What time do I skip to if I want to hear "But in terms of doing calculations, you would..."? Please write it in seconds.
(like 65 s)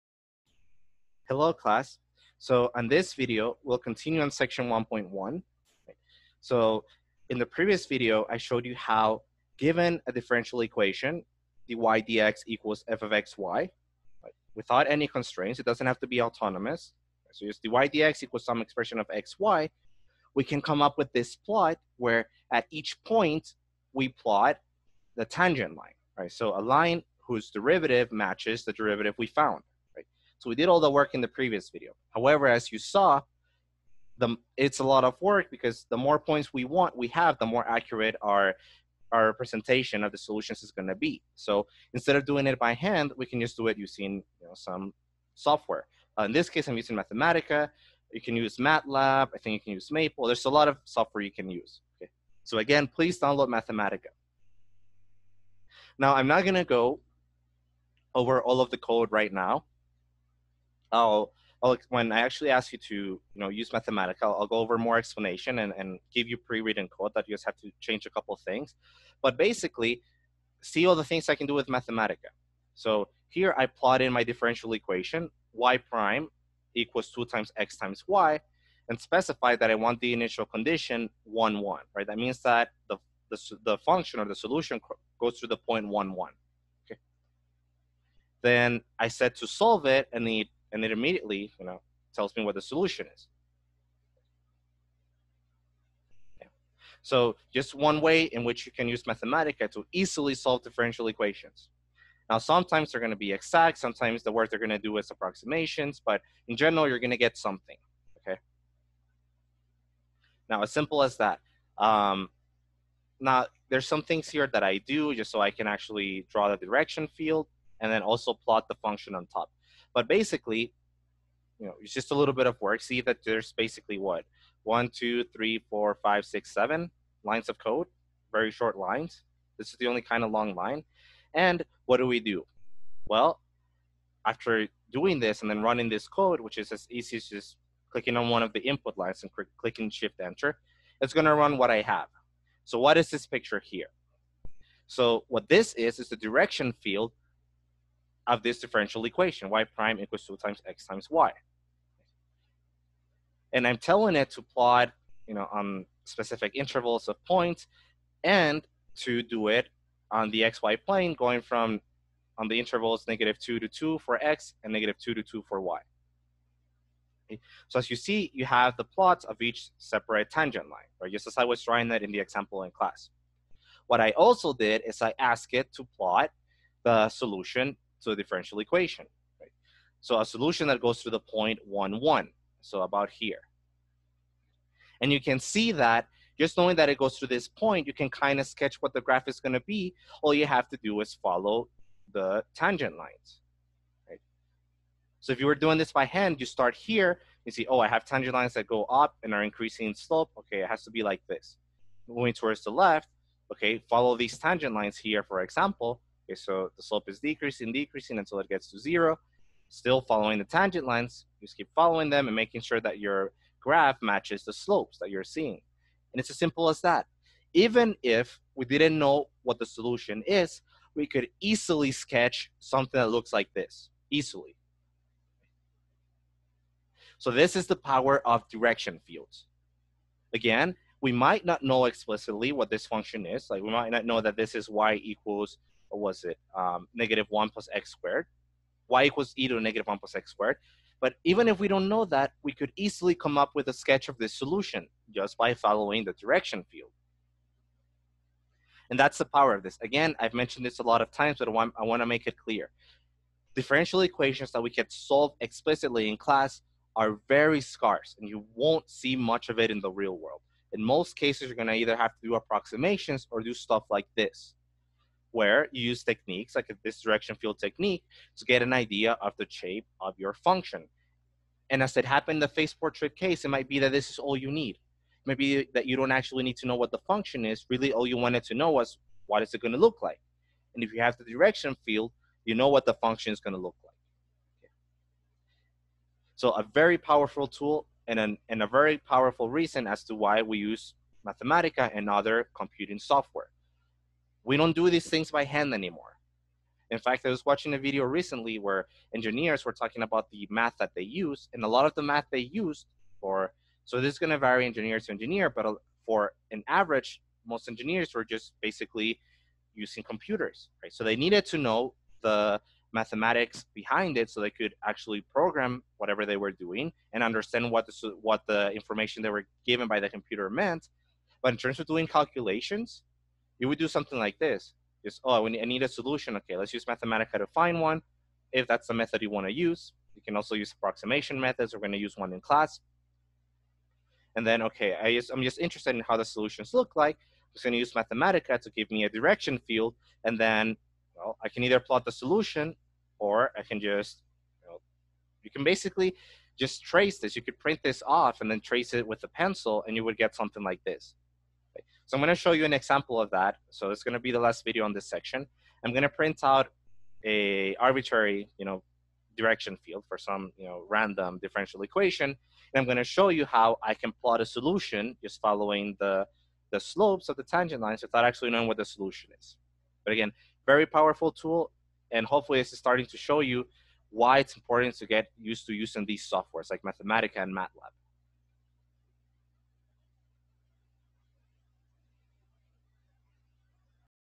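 321 s.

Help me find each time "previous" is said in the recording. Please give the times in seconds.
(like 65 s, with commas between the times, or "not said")
7 s, 31 s.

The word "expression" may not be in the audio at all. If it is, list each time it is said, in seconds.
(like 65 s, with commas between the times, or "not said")
18 s.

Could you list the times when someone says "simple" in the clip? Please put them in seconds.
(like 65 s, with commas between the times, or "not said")
110 s, 216 s.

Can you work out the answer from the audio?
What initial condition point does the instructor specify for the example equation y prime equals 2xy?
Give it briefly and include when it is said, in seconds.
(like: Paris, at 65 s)
1, 1, at 80 s.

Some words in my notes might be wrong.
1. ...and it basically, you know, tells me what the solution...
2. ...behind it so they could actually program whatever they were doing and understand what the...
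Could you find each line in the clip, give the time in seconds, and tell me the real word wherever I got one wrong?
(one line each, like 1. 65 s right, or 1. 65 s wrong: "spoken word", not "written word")
1. 90 s wrong: "immediately", not "basically"
2. 313 s right.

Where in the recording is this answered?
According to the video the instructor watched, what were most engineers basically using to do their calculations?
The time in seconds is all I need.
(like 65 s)
308 s.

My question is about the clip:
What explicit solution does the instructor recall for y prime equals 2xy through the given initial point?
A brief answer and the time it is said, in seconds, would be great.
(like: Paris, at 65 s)
y = e^(-1 + x^2), at 238 s.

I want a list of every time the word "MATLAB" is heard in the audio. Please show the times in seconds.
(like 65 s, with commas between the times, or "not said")
48 s, 377 s.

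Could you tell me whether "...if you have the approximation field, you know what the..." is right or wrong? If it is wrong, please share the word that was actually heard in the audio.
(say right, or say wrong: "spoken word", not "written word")
wrong: "direction", not "approximation".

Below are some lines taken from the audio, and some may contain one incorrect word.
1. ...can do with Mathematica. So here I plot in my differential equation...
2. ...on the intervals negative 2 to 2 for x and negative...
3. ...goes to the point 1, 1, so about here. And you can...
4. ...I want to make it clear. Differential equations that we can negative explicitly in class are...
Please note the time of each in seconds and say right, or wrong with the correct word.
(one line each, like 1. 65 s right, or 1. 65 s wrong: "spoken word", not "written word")
1. 71 s right
2. 162 s right
3. 180 s right
4. 251 s wrong: "solve", not "negative".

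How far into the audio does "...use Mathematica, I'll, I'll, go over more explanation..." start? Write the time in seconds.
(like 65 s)
63 s.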